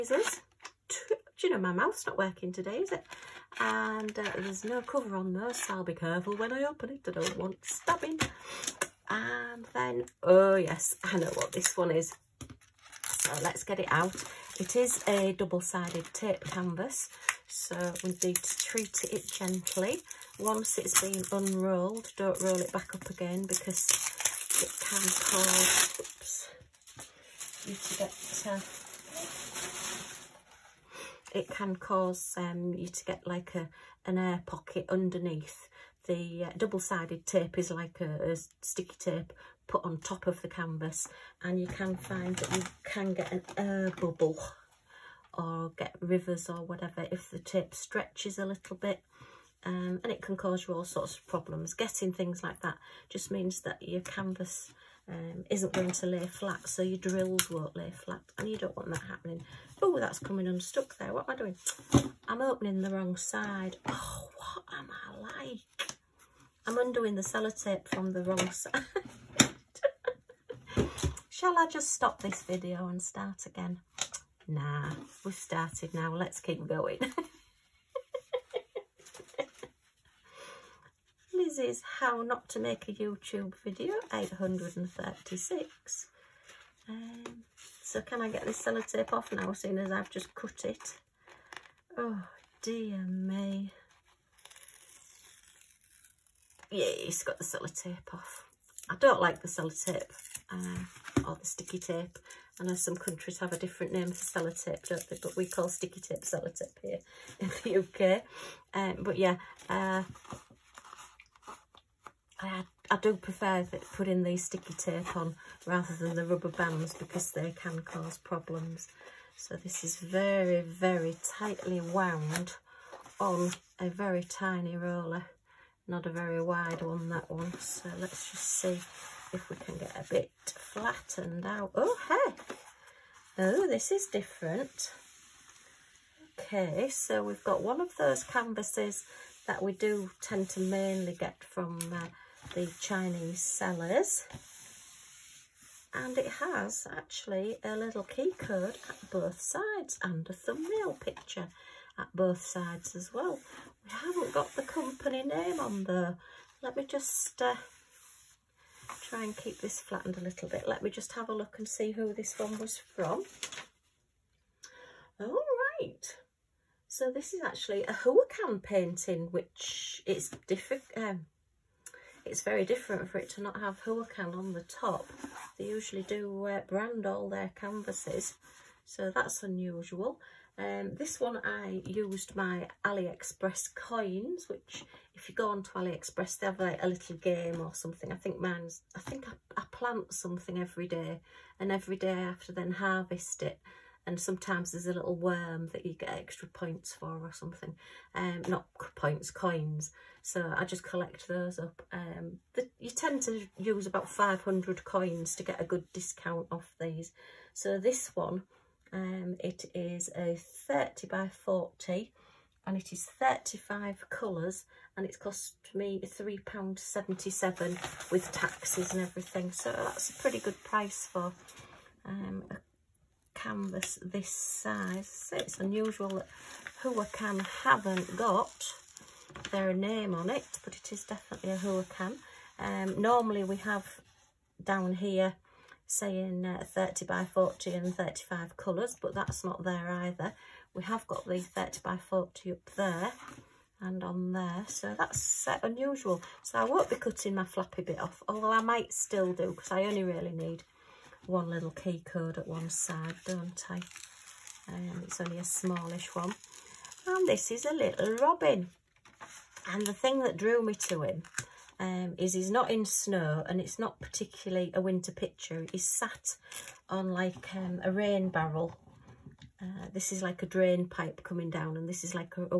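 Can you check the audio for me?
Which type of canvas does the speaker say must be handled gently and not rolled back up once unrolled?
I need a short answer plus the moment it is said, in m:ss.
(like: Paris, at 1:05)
Double-sided tape canvas, at 0:15.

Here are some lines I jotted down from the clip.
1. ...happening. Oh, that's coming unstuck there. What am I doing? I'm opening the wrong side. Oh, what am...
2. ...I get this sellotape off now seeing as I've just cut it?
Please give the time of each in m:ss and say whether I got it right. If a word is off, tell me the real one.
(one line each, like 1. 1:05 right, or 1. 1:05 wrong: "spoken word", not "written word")
1. 0:59 right
2. 1:28 right.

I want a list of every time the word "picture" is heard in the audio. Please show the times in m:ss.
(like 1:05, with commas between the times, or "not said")
2:30, 4:25.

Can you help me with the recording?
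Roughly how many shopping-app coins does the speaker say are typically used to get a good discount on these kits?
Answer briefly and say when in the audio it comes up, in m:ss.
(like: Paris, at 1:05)
500, at 3:24.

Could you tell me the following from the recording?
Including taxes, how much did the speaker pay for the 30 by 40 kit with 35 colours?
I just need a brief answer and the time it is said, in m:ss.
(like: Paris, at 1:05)
£3.77, at 3:36.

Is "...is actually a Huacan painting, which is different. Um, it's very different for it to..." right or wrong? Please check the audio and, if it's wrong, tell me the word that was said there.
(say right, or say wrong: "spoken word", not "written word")
right.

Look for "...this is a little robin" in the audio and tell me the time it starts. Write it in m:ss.
4:17.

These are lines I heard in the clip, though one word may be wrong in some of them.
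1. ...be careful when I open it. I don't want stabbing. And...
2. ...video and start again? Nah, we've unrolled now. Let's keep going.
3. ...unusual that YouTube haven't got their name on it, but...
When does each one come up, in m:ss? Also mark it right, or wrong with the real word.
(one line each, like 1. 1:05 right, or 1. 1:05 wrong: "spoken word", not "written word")
1. 0:05 right
2. 1:12 wrong: "started", not "unrolled"
3. 3:45 wrong: "Huacan", not "YouTube".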